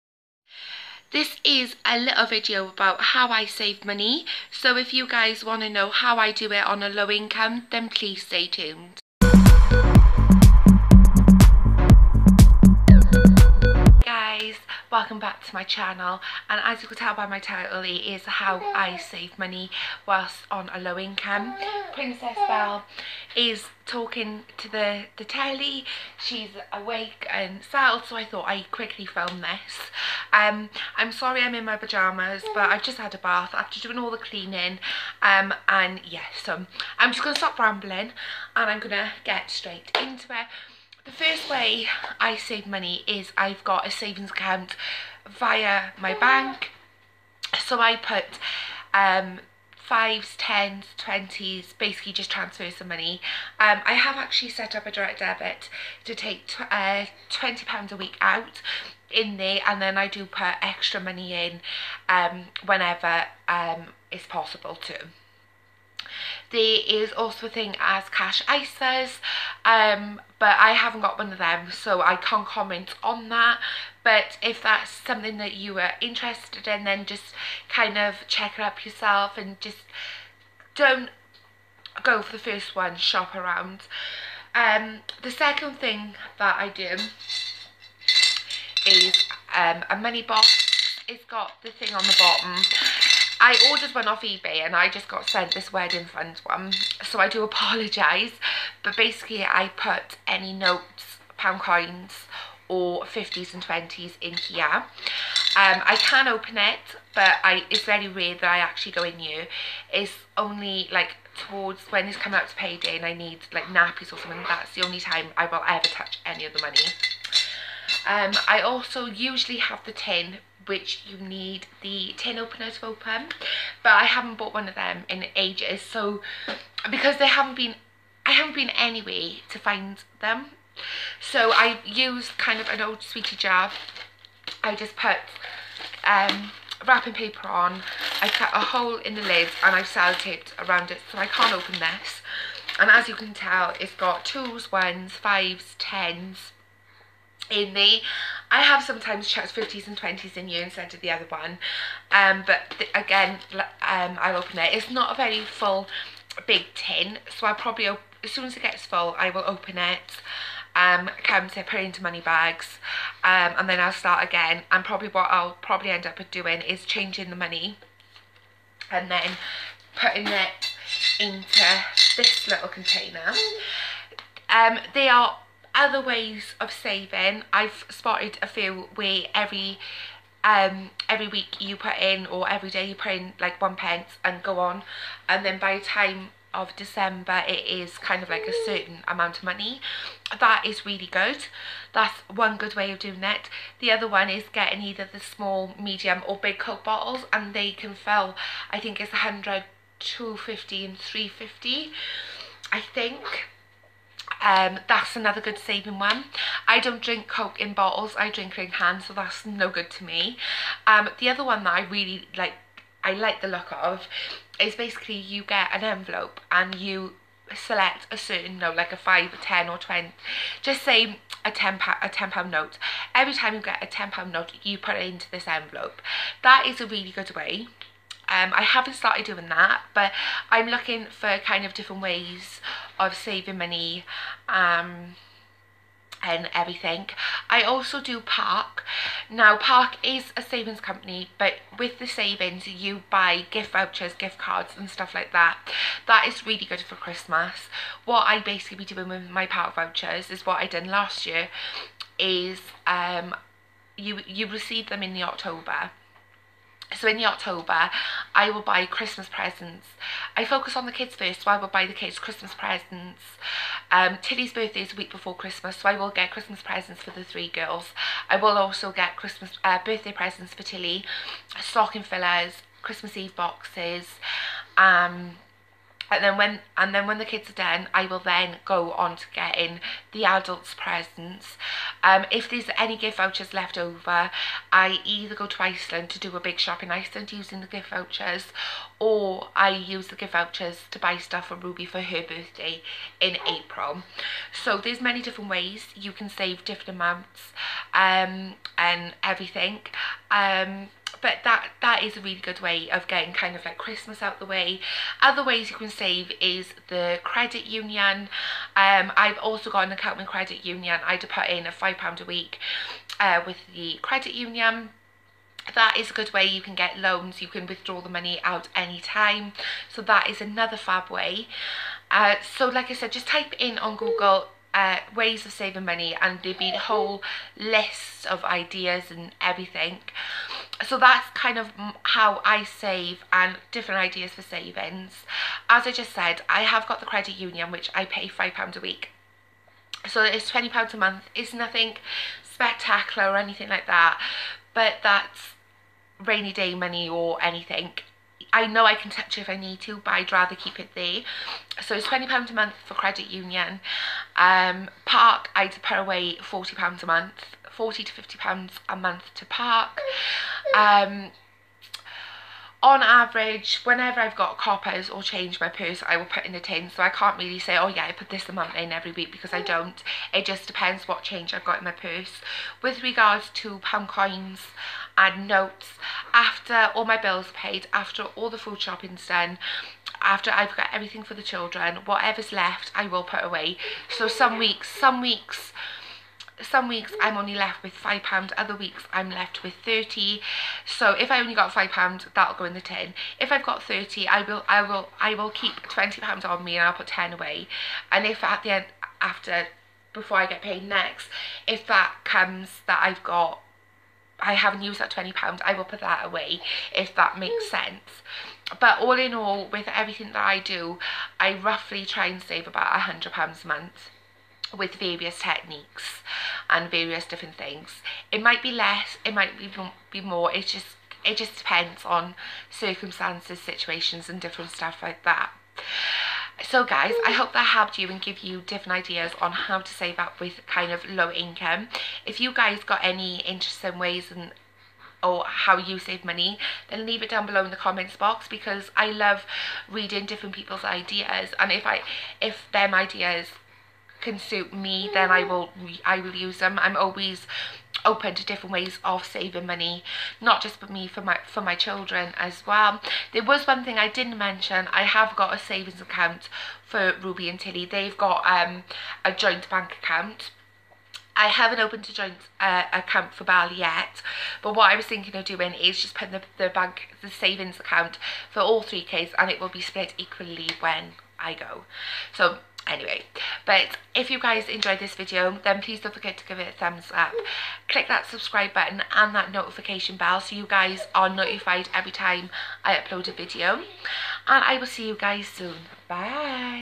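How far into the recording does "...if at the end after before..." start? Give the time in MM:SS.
06:38.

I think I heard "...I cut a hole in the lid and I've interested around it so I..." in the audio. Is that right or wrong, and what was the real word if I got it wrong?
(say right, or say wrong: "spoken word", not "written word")
wrong: "sellotaped", not "interested".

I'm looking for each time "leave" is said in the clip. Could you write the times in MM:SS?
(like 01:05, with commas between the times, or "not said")
07:17.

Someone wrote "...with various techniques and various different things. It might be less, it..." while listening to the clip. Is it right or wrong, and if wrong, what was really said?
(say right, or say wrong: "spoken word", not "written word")
right.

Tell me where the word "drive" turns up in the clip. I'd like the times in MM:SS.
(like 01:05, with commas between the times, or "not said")
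not said.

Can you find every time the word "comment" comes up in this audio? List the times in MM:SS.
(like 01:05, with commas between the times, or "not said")
01:12, 07:17.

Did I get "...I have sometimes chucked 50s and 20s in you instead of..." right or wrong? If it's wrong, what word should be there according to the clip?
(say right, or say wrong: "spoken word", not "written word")
right.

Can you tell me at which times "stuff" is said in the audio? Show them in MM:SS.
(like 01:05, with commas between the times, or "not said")
04:04, 04:51, 07:04.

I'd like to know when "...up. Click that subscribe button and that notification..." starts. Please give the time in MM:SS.
07:57.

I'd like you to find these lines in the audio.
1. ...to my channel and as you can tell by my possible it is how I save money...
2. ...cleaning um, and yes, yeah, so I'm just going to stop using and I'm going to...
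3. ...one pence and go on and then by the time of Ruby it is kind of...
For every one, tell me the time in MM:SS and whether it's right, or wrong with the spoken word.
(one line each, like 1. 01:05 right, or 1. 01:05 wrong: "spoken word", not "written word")
1. 00:15 wrong: "title", not "possible"
2. 00:34 wrong: "rambling", not "using"
3. 03:03 wrong: "December", not "Ruby".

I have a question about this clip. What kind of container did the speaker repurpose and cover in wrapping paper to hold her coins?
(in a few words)
old sweetie jar.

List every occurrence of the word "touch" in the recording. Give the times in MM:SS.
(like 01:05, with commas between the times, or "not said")
01:55, 05:49.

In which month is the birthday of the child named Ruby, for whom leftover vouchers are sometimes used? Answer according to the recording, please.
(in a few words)
April.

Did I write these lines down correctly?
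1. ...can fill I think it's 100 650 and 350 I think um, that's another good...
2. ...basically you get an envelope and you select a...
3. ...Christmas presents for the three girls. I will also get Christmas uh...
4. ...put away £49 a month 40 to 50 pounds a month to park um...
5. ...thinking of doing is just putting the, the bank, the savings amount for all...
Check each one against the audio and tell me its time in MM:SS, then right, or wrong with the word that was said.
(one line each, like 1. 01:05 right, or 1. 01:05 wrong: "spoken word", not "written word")
1. 03:17 wrong: "250", not "650"
2. 03:34 right
3. 04:26 right
4. 05:55 wrong: "40", not "49"
5. 07:45 wrong: "account", not "amount".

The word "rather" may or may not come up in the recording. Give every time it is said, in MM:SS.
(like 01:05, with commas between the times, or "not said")
05:50.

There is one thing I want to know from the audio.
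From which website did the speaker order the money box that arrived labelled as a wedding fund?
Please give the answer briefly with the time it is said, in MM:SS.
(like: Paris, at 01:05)
eBay, at 01:34.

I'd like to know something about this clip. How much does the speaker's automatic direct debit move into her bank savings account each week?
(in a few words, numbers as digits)
£20.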